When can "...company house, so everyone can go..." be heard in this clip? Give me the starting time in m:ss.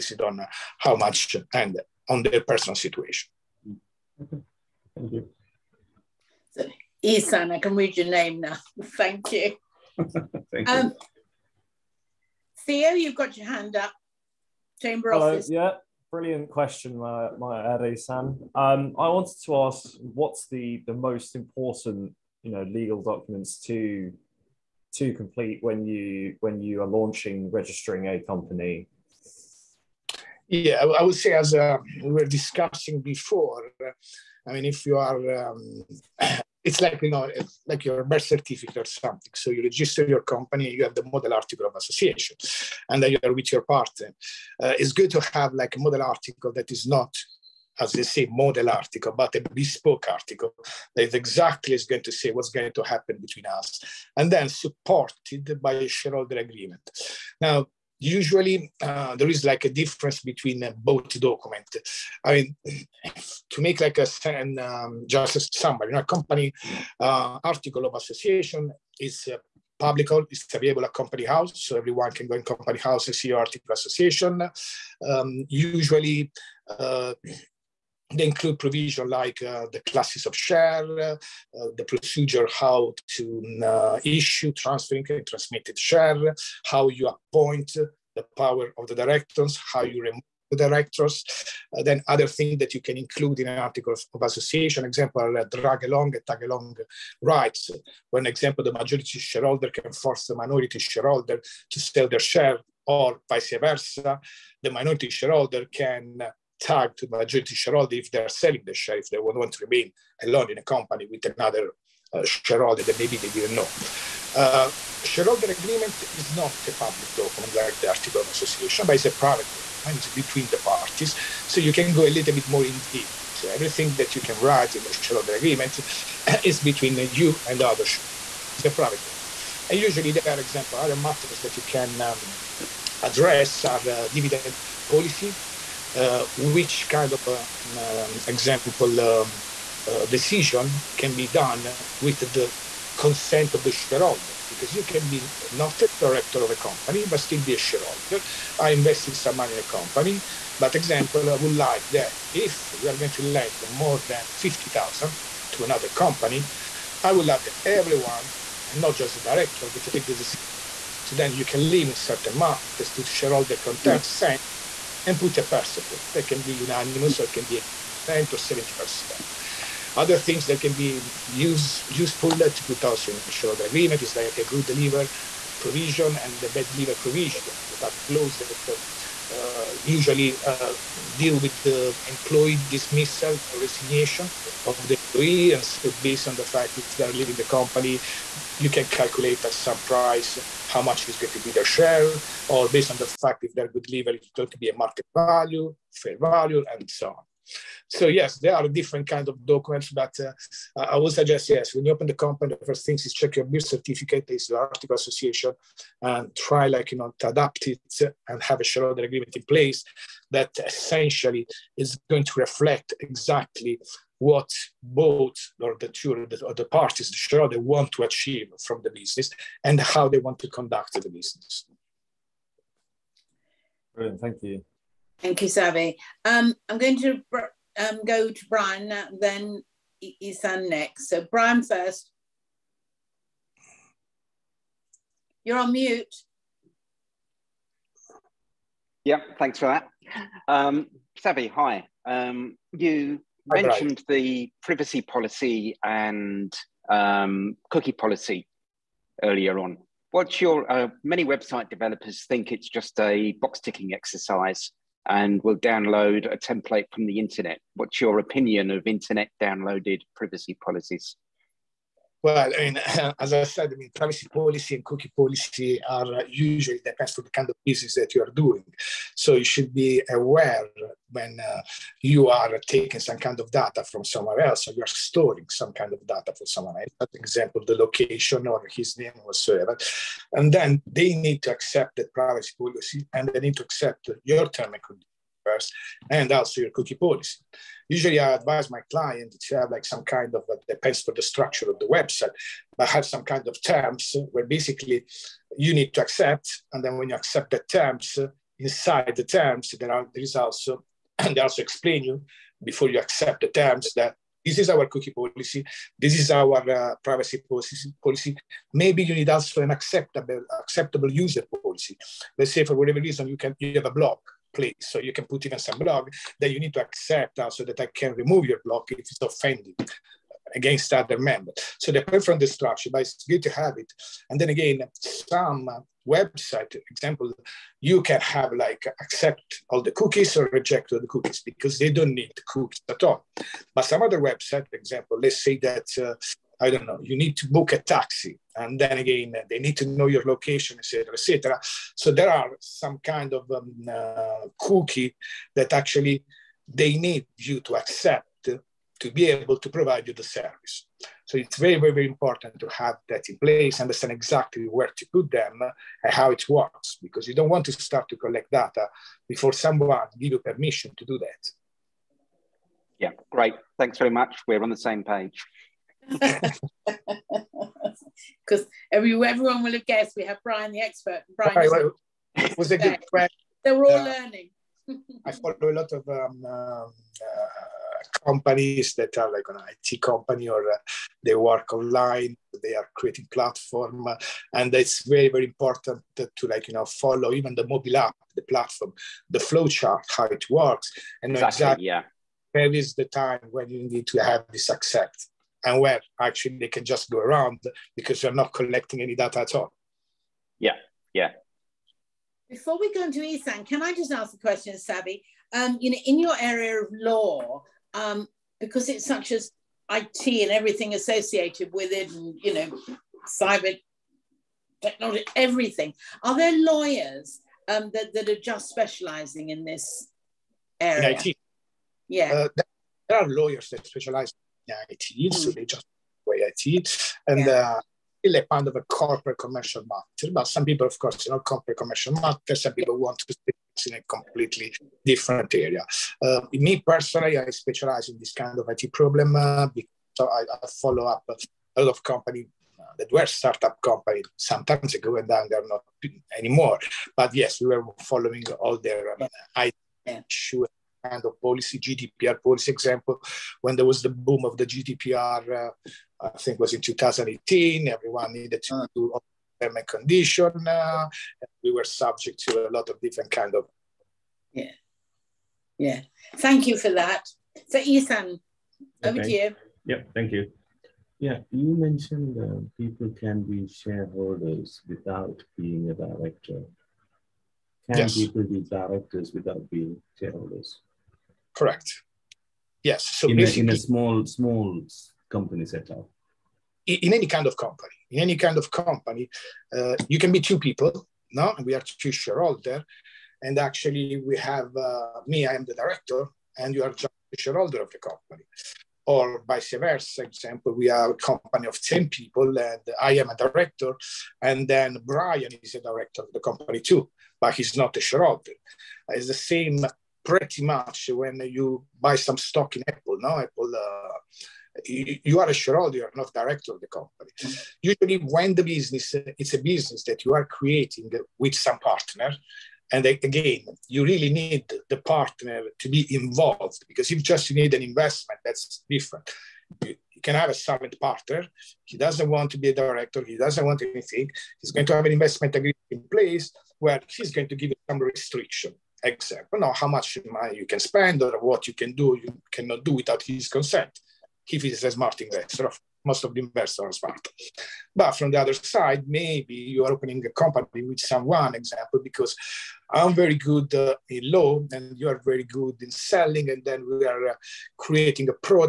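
1:10.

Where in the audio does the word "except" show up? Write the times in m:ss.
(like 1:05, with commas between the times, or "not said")
8:59.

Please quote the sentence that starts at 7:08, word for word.
uh, kind of a corporate commercial matter.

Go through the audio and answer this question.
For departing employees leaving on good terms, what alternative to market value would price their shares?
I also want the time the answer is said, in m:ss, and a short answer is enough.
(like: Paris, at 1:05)
Fair value, at 3:15.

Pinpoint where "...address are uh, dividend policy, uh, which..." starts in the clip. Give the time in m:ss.
2:13.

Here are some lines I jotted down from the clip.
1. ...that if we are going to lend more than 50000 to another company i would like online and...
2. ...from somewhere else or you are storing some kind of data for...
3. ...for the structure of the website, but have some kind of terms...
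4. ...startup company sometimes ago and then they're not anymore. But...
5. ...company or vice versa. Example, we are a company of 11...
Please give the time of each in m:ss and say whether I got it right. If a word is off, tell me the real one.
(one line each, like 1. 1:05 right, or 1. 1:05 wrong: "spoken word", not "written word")
1. 2:31 wrong: "everyone", not "online"
2. 4:33 right
3. 4:51 right
4. 7:23 right
5. 8:17 wrong: "10", not "11".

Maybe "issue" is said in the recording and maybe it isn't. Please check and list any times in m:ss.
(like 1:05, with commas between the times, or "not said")
1:24, 7:30.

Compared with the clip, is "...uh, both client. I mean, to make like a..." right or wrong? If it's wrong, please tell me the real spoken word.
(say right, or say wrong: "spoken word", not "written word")
wrong: "document", not "client".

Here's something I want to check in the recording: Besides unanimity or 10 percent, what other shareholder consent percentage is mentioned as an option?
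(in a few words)
70 percent.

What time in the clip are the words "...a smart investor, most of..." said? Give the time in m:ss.
9:04.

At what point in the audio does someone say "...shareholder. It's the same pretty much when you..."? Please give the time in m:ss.
8:28.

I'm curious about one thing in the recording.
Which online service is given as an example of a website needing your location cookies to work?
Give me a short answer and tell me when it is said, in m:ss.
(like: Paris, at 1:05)
Book a taxi, at 5:37.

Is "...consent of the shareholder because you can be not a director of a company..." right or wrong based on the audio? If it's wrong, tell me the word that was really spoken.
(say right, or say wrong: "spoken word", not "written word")
right.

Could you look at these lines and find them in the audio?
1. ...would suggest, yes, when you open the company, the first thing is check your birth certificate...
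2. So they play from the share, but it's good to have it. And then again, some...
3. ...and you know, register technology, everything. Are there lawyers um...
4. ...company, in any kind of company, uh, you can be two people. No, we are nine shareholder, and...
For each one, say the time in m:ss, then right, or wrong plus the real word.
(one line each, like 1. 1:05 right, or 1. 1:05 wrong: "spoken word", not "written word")
1. 3:20 right
2. 5:21 wrong: "structure", not "share"
3. 6:52 wrong: "cyber", not "register"
4. 8:07 wrong: "two", not "nine".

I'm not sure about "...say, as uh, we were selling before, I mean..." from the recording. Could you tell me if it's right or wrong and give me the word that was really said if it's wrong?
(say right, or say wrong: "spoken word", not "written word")
wrong: "discussing", not "selling".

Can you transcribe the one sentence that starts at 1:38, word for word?
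One example, the majority shareholder can force the minority shareholder to sell their share or vice versa.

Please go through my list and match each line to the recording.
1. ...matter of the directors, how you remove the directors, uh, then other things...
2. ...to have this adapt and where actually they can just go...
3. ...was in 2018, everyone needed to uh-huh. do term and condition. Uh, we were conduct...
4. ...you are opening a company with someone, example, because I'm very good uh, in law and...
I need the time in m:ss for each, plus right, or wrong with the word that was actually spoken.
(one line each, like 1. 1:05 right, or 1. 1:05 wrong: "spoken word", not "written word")
1. 1:28 wrong: "power", not "matter"
2. 6:34 wrong: "accept", not "adapt"
3. 7:36 wrong: "subject", not "conduct"
4. 9:09 right.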